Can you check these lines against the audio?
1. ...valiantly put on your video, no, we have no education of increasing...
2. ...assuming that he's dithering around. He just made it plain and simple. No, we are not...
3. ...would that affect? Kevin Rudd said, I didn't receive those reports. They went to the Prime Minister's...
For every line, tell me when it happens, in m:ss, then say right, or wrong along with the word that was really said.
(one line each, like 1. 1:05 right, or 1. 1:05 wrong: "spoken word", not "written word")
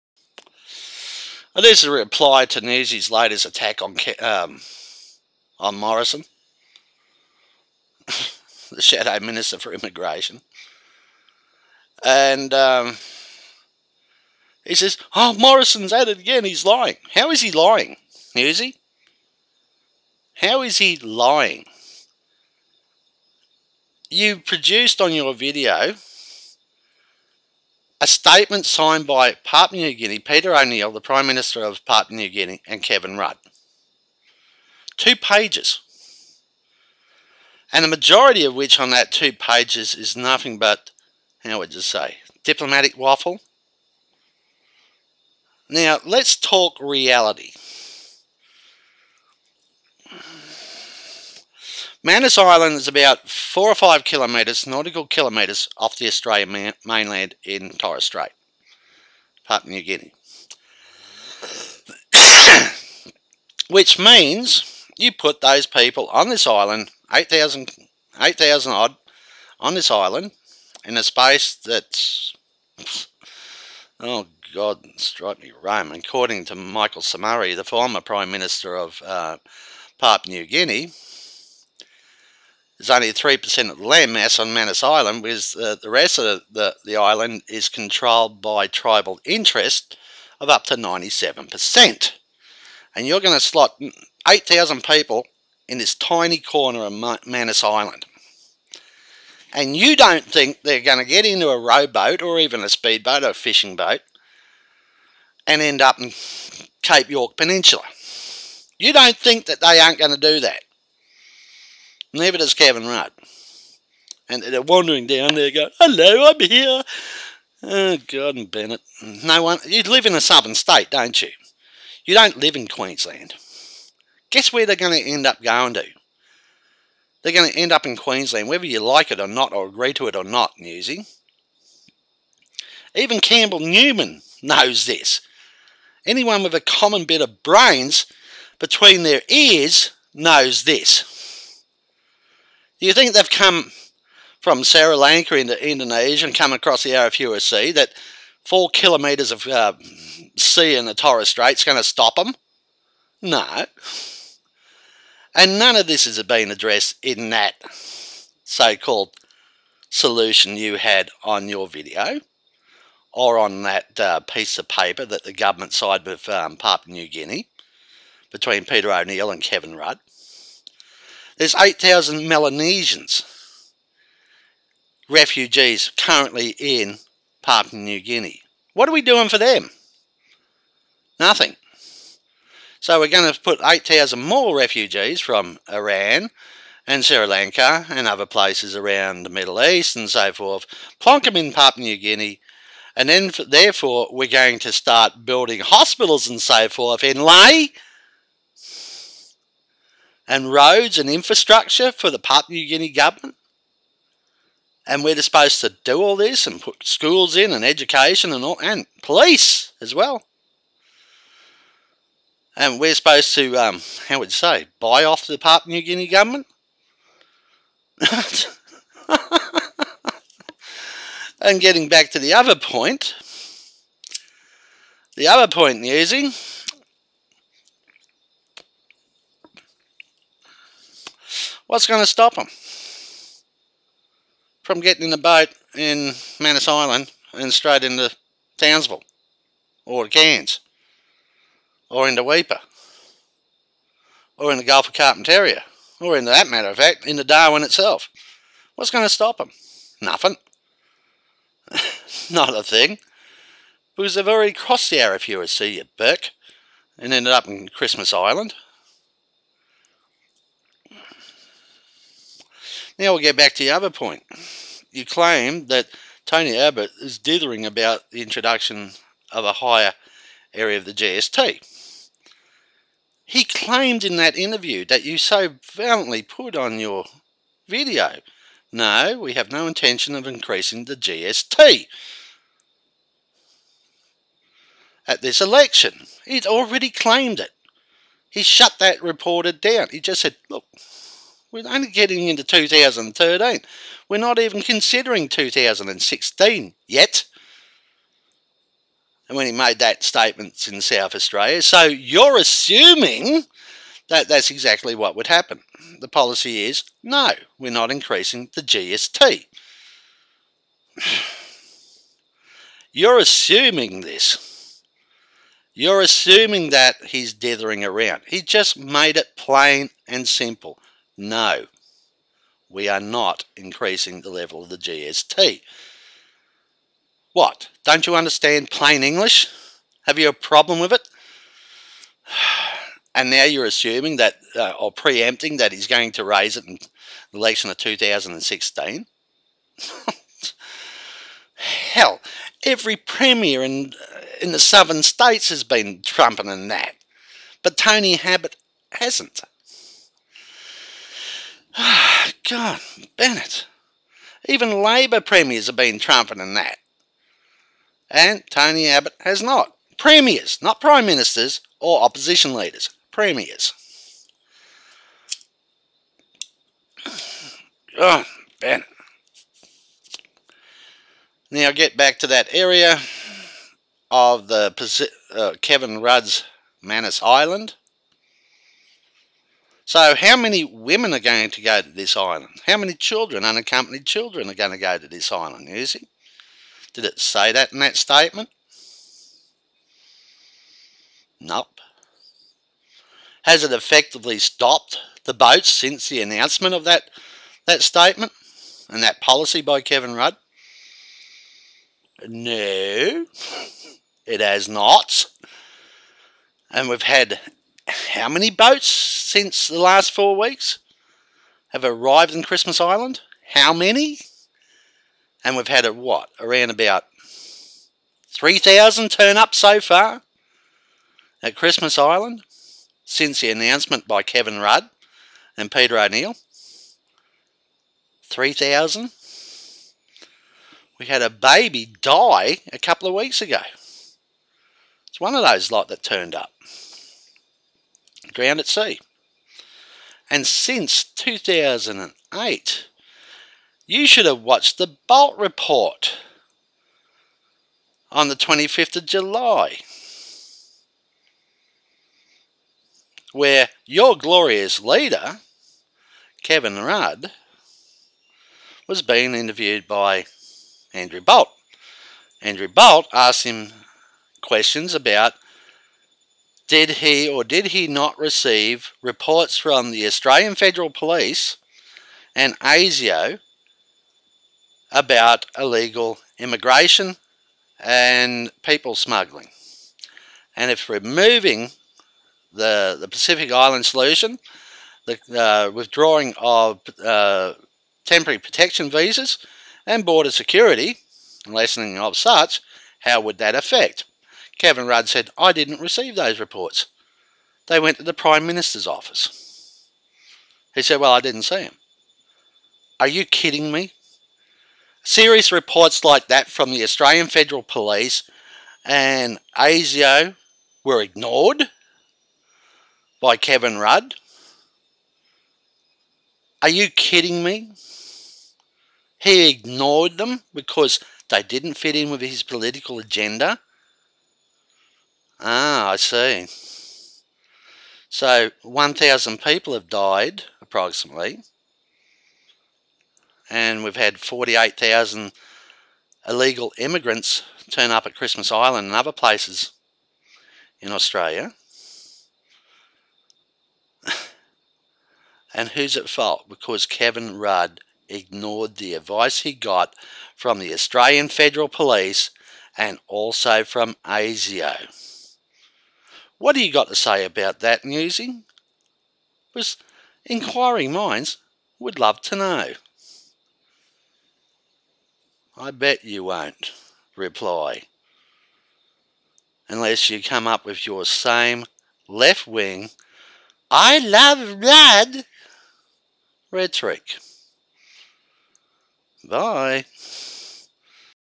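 1. 4:35 wrong: "intention", not "education"
2. 5:16 right
3. 8:13 right.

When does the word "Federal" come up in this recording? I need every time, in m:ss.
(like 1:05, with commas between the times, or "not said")
7:50, 8:27, 9:11.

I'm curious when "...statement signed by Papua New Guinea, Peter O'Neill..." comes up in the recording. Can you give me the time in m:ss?
0:28.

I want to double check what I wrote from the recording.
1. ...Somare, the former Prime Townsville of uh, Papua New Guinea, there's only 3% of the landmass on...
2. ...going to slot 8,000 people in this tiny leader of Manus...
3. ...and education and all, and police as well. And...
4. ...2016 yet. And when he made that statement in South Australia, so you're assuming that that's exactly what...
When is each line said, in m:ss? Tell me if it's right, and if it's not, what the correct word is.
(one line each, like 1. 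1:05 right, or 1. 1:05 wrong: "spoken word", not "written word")
1. 1:17 wrong: "Minister", not "Townsville"
2. 1:33 wrong: "corner", not "leader"
3. 3:27 right
4. 4:55 right.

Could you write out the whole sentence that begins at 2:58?
What are we doing for them?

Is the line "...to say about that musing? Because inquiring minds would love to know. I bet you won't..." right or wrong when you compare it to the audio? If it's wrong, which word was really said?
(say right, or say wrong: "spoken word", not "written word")
right.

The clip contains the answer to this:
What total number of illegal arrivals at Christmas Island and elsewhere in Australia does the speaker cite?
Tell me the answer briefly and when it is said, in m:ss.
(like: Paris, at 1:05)
48,000, at 8:54.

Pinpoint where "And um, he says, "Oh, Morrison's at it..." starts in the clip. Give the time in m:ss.
0:12.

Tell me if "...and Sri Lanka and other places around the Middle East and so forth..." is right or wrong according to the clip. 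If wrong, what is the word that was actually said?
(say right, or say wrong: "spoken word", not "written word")
right.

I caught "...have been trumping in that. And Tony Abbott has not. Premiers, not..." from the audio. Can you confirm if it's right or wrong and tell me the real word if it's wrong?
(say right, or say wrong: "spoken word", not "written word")
right.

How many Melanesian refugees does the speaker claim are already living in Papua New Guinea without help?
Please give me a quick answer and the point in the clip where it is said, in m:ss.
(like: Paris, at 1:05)
8,000, at 2:51.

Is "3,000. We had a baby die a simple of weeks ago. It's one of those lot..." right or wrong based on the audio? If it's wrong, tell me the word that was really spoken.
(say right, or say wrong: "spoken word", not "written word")
wrong: "couple", not "simple".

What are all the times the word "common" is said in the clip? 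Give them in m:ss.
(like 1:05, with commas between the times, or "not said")
2:16.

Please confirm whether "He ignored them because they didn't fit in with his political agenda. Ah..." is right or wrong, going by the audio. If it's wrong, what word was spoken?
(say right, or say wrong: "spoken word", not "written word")
right.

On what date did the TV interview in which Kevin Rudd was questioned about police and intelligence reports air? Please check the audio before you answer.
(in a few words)
25 July.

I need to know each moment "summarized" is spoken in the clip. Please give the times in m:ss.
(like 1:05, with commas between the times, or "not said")
not said.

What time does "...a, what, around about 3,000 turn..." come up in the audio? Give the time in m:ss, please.
6:55.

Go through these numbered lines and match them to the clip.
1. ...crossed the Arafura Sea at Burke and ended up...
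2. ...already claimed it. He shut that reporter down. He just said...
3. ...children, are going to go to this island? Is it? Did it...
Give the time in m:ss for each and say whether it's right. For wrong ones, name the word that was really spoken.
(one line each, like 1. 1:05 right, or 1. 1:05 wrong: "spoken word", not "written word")
1. 4:14 right
2. 4:46 right
3. 6:24 right.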